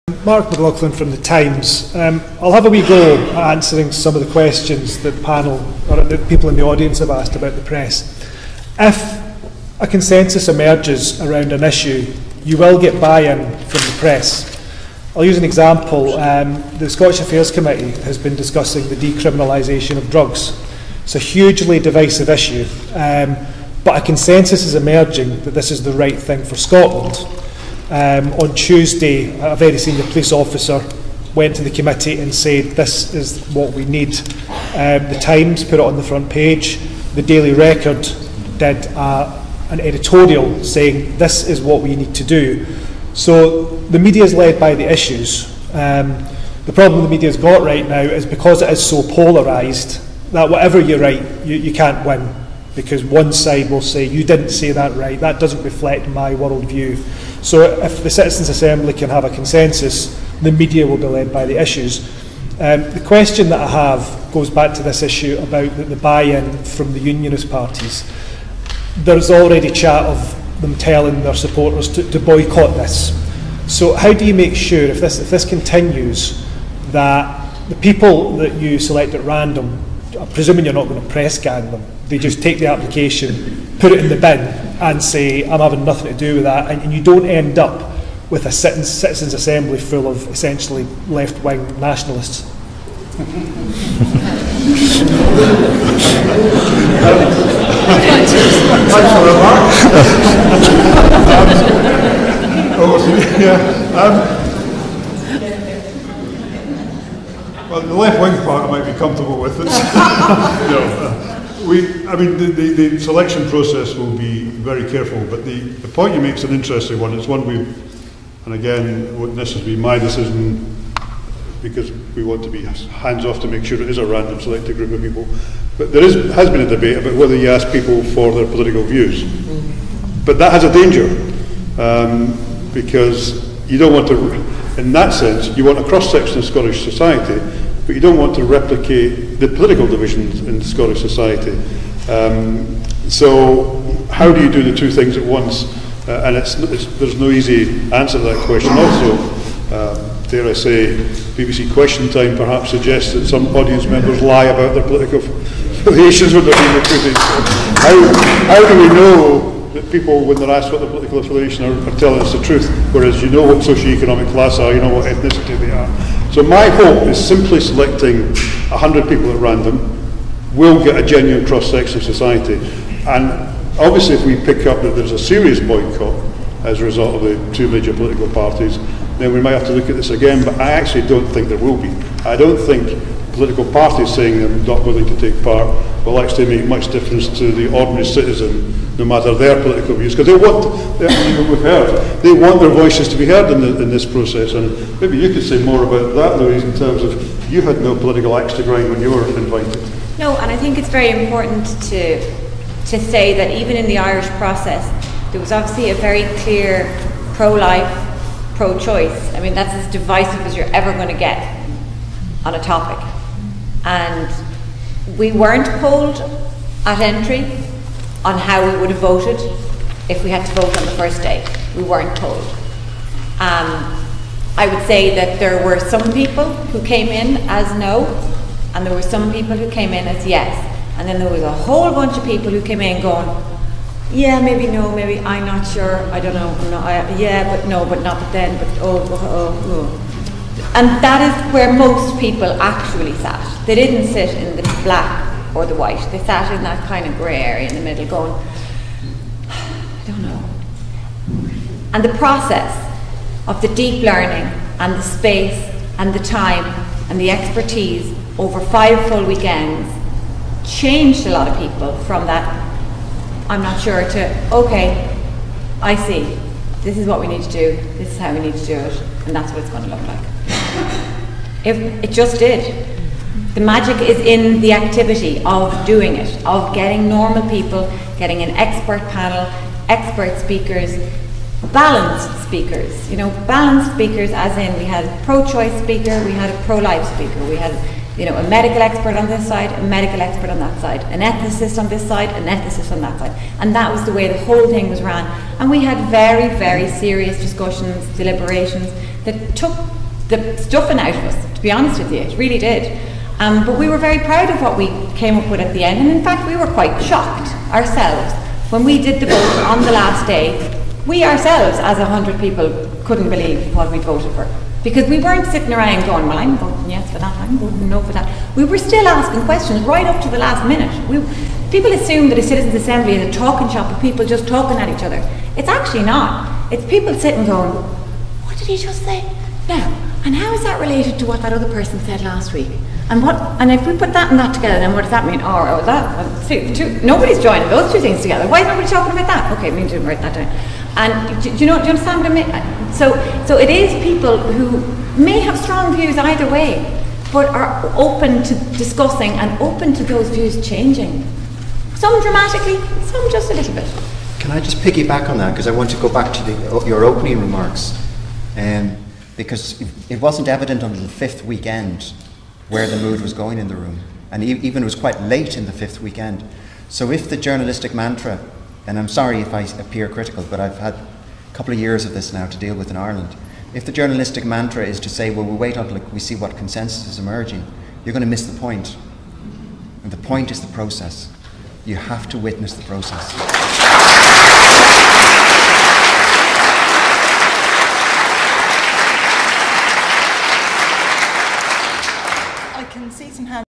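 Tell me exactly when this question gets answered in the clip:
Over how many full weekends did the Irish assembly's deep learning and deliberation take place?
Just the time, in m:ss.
4:18.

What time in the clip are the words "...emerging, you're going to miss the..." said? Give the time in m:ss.
6:17.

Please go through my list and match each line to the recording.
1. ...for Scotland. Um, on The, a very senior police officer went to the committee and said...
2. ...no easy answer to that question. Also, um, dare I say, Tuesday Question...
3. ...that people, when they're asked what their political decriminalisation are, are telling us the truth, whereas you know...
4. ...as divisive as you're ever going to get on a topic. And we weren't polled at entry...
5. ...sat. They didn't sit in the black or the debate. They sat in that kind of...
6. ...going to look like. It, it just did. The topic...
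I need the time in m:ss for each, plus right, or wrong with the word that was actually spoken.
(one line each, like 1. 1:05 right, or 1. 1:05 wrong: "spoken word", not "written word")
1. 0:26 wrong: "Tuesday", not "The"
2. 2:27 wrong: "BBC", not "Tuesday"
3. 2:39 wrong: "affiliation", not "decriminalisation"
4. 3:29 right
5. 4:03 wrong: "white", not "debate"
6. 4:29 wrong: "magic", not "topic".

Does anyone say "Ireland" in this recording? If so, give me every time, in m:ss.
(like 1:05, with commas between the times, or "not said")
6:12.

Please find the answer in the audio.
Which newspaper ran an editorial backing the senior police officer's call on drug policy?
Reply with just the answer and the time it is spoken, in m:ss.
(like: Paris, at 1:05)
Daily Record, at 0:37.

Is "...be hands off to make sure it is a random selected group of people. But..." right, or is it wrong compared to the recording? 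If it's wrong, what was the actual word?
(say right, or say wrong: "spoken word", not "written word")
right.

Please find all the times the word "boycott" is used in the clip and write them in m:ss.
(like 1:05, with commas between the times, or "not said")
1:12, 2:55.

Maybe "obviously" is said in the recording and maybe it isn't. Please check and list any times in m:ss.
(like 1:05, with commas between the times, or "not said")
2:53, 3:25.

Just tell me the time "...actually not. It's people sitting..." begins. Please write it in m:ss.
5:25.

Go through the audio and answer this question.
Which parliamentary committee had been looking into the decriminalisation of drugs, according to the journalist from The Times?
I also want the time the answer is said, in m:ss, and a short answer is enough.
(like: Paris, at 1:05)
Scottish Affairs Committee, at 0:16.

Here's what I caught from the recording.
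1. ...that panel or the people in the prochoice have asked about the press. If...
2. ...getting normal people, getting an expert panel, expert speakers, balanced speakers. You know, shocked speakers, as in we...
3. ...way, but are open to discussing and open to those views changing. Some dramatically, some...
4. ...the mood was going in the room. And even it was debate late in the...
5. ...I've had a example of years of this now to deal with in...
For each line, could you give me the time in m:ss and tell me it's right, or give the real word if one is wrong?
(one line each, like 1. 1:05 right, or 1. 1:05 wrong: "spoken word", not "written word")
1. 0:05 wrong: "audience", not "prochoice"
2. 4:36 wrong: "balanced", not "shocked"
3. 5:46 right
4. 6:02 wrong: "quite", not "debate"
5. 6:10 wrong: "couple", not "example".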